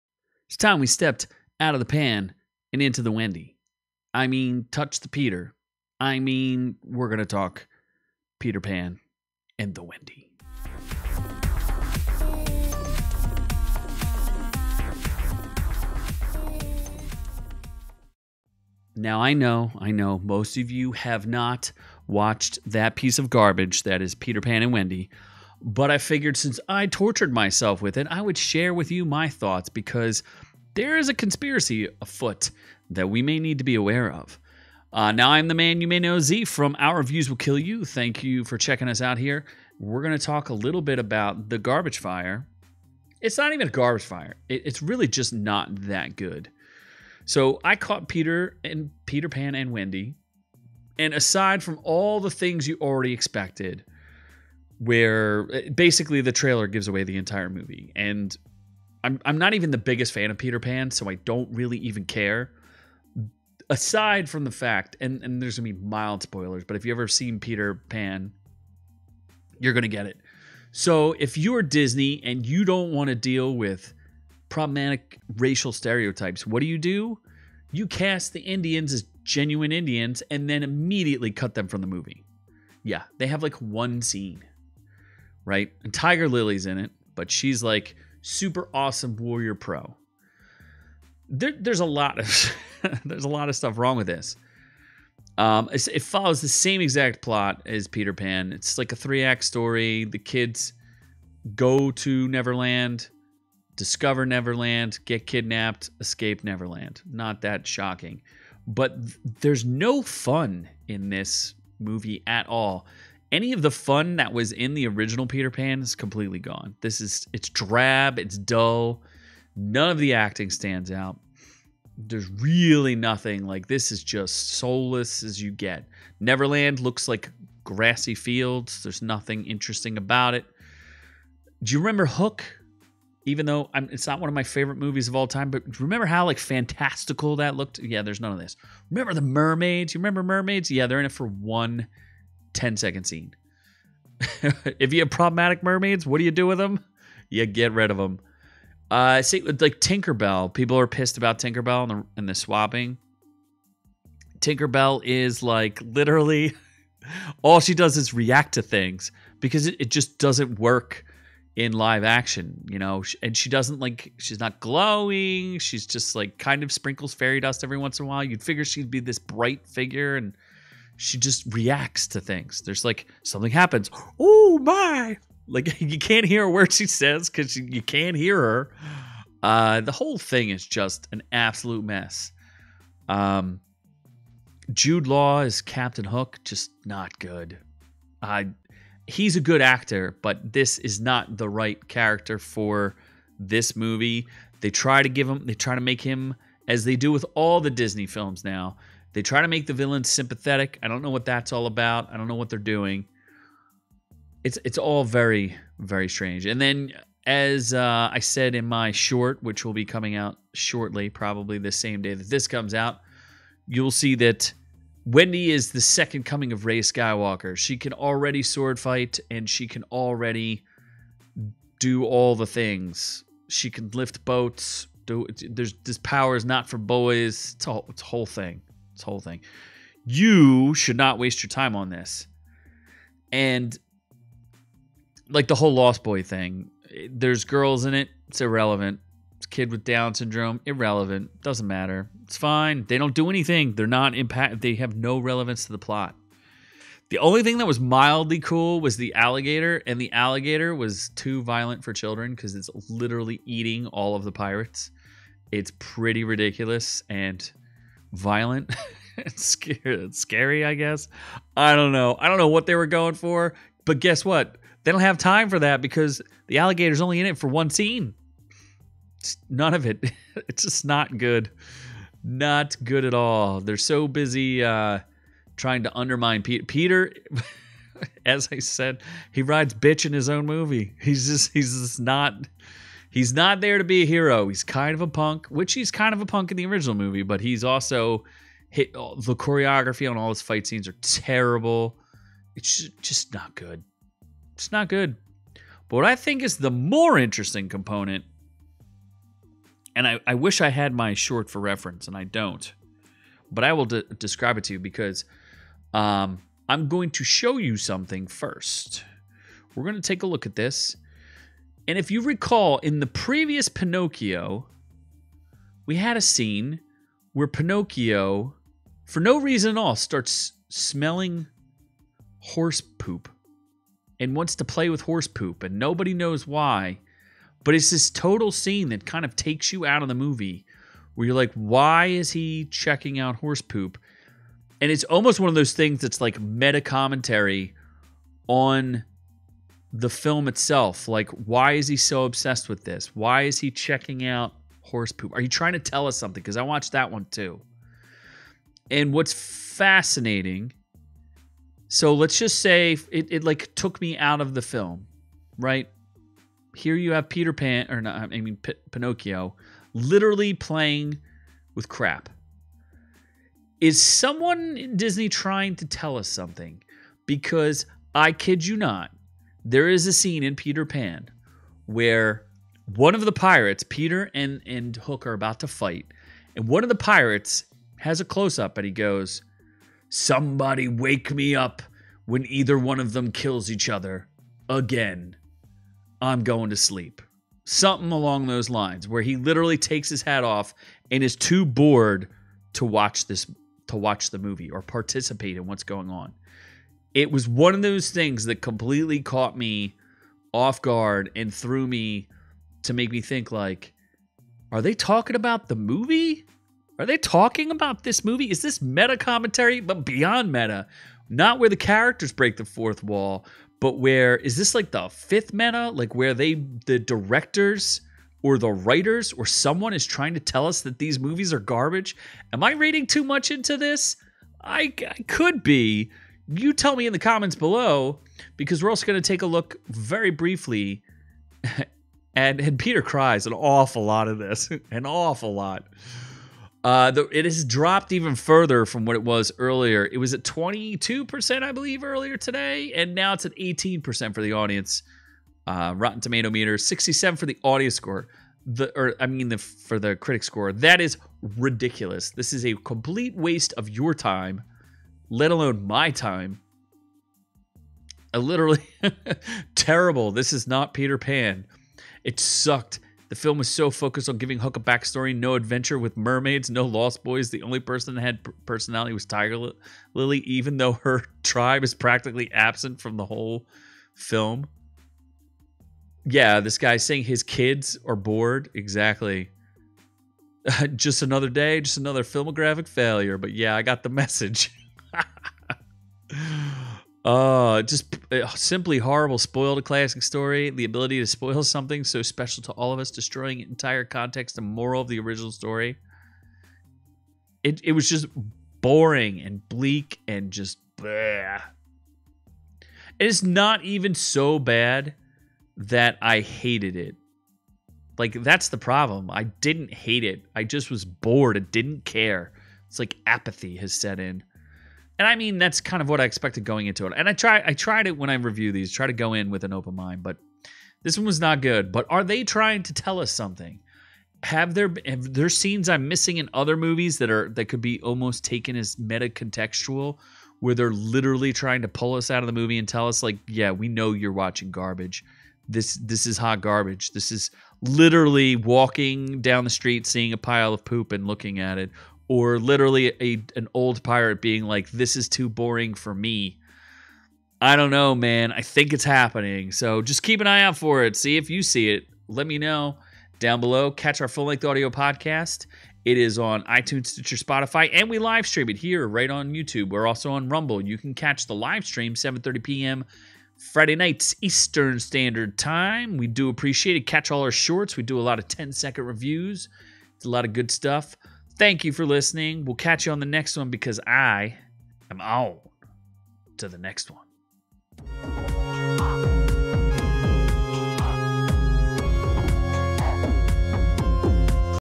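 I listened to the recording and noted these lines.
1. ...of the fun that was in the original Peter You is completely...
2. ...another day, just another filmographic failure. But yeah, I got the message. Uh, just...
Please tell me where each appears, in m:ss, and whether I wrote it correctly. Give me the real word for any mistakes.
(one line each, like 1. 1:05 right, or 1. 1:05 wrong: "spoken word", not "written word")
1. 1:53 wrong: "Pan", not "You"
2. 8:01 right.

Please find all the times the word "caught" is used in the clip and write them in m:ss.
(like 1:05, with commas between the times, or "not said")
0:47, 6:39.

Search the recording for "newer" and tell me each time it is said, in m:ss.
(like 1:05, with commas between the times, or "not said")
not said.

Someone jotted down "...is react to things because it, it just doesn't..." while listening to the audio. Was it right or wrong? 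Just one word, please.
right.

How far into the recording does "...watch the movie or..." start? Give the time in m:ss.
6:33.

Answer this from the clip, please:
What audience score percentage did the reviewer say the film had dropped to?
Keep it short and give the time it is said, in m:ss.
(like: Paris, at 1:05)
18%, at 7:23.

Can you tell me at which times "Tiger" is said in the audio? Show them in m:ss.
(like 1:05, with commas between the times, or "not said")
1:25, 7:49.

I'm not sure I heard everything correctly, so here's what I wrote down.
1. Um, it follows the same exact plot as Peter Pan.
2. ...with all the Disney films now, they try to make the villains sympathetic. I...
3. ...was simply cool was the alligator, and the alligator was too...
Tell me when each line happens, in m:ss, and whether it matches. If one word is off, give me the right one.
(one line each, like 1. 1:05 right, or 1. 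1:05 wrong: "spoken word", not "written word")
1. 1:35 right
2. 3:17 right
3. 4:07 wrong: "mildly", not "simply".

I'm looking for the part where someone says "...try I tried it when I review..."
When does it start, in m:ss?
8:37.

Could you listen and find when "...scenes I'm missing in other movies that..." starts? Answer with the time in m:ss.
8:45.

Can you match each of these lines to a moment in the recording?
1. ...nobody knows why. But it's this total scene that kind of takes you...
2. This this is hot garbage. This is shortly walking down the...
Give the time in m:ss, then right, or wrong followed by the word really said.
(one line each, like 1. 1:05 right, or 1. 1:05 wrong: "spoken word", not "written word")
1. 5:25 right
2. 8:55 wrong: "literally", not "shortly".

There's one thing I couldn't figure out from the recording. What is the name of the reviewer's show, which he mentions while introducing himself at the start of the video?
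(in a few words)
Our Reviews Will Kill You.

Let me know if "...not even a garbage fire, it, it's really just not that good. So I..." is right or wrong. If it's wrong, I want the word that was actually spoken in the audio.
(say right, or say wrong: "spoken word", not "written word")
right.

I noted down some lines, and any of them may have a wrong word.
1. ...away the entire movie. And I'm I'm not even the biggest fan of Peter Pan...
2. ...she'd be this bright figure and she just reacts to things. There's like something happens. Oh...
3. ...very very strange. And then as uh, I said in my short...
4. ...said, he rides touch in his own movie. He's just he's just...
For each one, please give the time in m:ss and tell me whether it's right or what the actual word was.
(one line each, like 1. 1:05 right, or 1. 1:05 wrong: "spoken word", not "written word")
1. 0:56 right
2. 2:48 right
3. 3:25 right
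4. 4:38 wrong: "bitch", not "touch".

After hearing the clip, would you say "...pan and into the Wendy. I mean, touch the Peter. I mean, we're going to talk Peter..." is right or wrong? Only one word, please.
right.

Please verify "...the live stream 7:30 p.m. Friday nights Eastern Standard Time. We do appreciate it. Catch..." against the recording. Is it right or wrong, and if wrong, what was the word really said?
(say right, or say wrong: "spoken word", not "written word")
right.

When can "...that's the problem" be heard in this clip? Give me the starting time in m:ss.
8:28.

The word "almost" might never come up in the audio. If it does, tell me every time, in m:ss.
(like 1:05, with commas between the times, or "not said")
5:35, 8:48.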